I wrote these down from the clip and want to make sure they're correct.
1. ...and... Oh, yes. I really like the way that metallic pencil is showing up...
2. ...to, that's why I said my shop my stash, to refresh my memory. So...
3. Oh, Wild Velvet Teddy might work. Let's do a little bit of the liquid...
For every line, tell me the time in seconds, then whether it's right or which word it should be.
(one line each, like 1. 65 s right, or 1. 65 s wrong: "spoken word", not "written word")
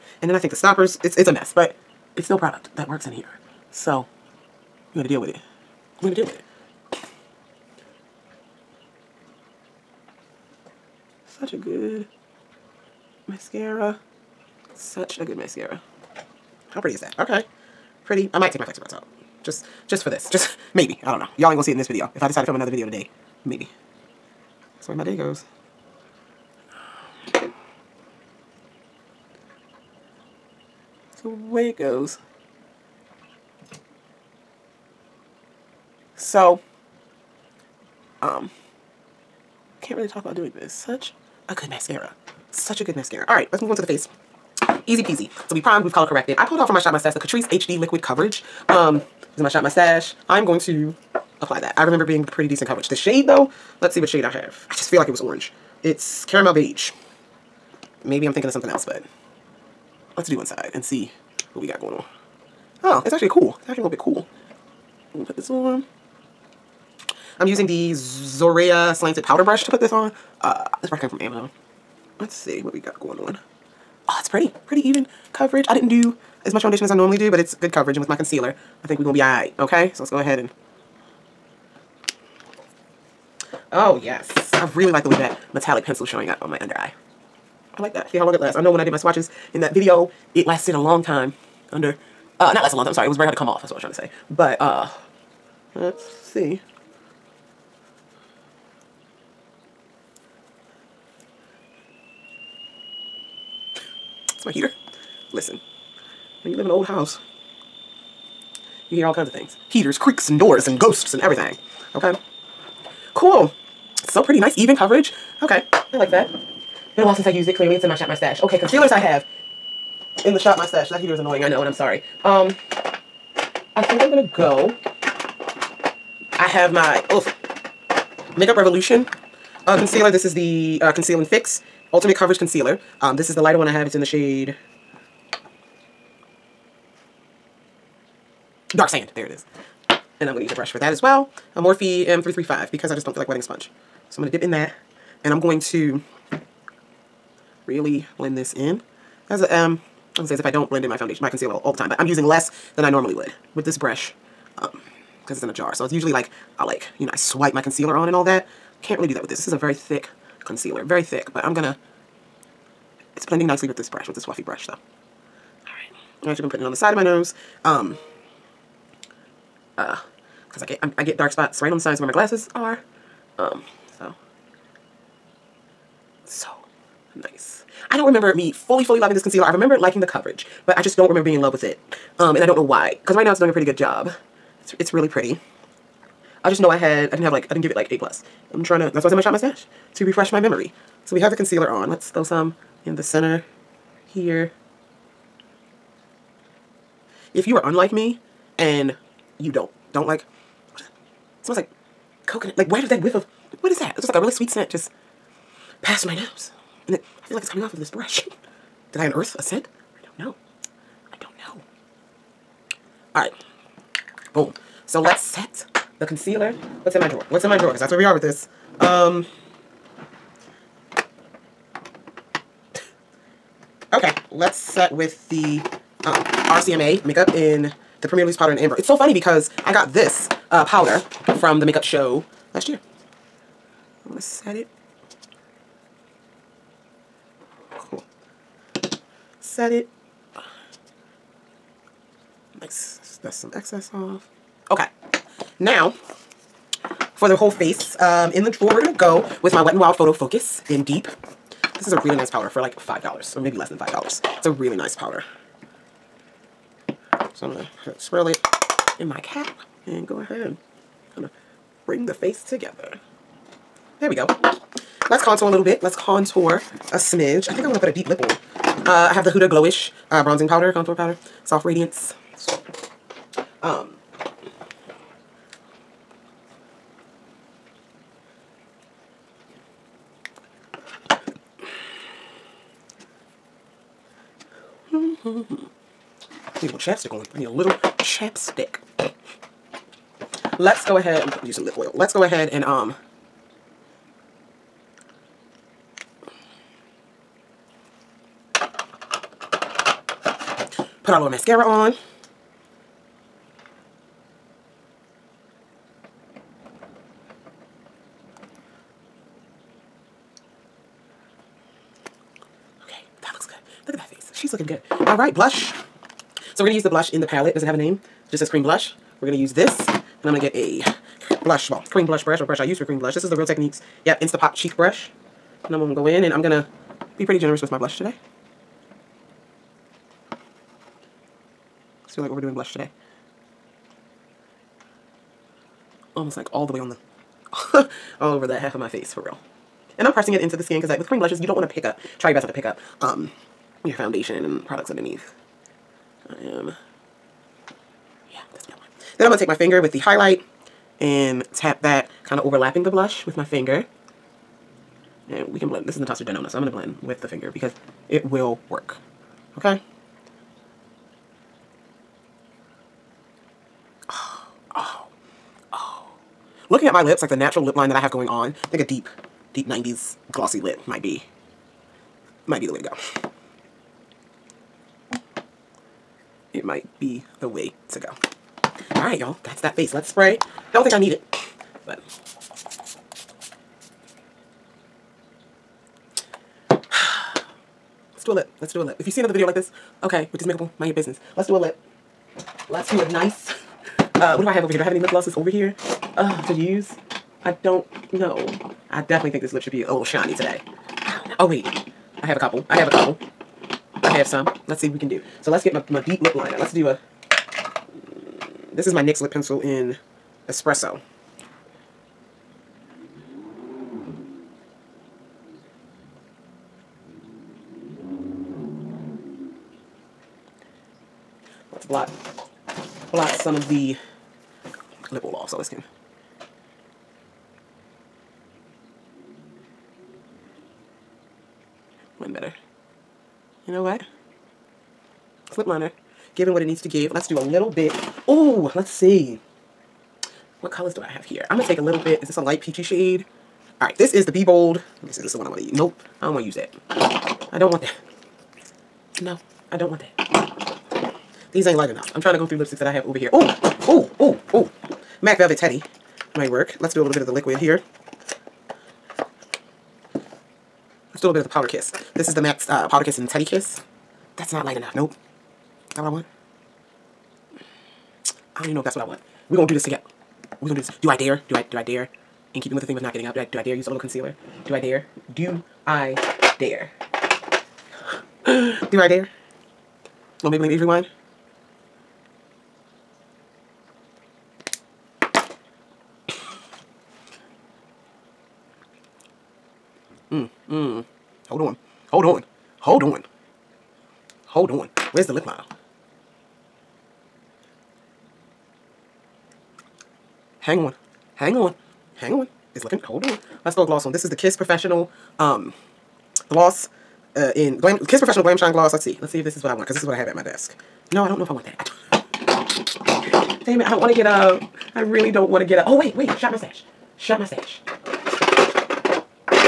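1. 80 s right
2. 188 s right
3. 454 s wrong: "MAC", not "Wild".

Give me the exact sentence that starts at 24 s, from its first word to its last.
That's the way my day goes.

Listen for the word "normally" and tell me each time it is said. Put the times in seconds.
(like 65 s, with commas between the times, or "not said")
76 s, 152 s.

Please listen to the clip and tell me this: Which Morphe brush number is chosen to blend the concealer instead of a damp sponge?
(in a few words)
M335.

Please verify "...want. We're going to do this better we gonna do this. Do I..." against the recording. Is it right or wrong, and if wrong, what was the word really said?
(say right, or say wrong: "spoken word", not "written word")
wrong: "together", not "better".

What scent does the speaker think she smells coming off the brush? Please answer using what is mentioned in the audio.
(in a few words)
coconut.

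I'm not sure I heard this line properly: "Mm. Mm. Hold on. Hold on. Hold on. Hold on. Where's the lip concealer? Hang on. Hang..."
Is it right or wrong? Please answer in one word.
wrong.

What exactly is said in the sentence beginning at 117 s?
Clearly, it's in my shop, my stash.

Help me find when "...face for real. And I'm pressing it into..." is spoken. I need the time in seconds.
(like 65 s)
338 s.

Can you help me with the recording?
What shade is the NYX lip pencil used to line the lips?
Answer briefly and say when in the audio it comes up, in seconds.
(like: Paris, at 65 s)
Espresso, at 410 s.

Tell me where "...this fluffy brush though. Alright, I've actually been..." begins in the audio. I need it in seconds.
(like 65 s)
164 s.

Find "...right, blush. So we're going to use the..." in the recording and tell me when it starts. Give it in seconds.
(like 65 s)
315 s.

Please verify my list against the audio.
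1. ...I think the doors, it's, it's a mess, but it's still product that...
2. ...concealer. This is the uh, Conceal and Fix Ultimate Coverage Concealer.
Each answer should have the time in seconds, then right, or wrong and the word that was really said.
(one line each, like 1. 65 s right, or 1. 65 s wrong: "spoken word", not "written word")
1. 0 s wrong: "stoppers", not "doors"
2. 129 s right.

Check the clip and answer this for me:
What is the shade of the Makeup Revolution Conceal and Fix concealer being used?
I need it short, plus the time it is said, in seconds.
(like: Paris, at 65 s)
Dark Sand, at 138 s.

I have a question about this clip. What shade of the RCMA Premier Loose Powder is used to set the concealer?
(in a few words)
Amber.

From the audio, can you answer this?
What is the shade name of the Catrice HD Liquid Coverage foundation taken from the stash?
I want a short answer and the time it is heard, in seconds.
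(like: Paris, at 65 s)
Caramel Beige, at 56 s.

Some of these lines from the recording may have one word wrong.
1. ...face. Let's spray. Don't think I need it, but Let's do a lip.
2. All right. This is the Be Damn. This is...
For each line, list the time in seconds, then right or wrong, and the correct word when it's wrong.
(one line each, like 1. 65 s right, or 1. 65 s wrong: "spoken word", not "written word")
1. 379 s right
2. 443 s wrong: "Bold", not "Damn".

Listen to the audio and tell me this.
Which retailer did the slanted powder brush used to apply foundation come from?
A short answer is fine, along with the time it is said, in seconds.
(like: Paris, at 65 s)
Amazon, at 71 s.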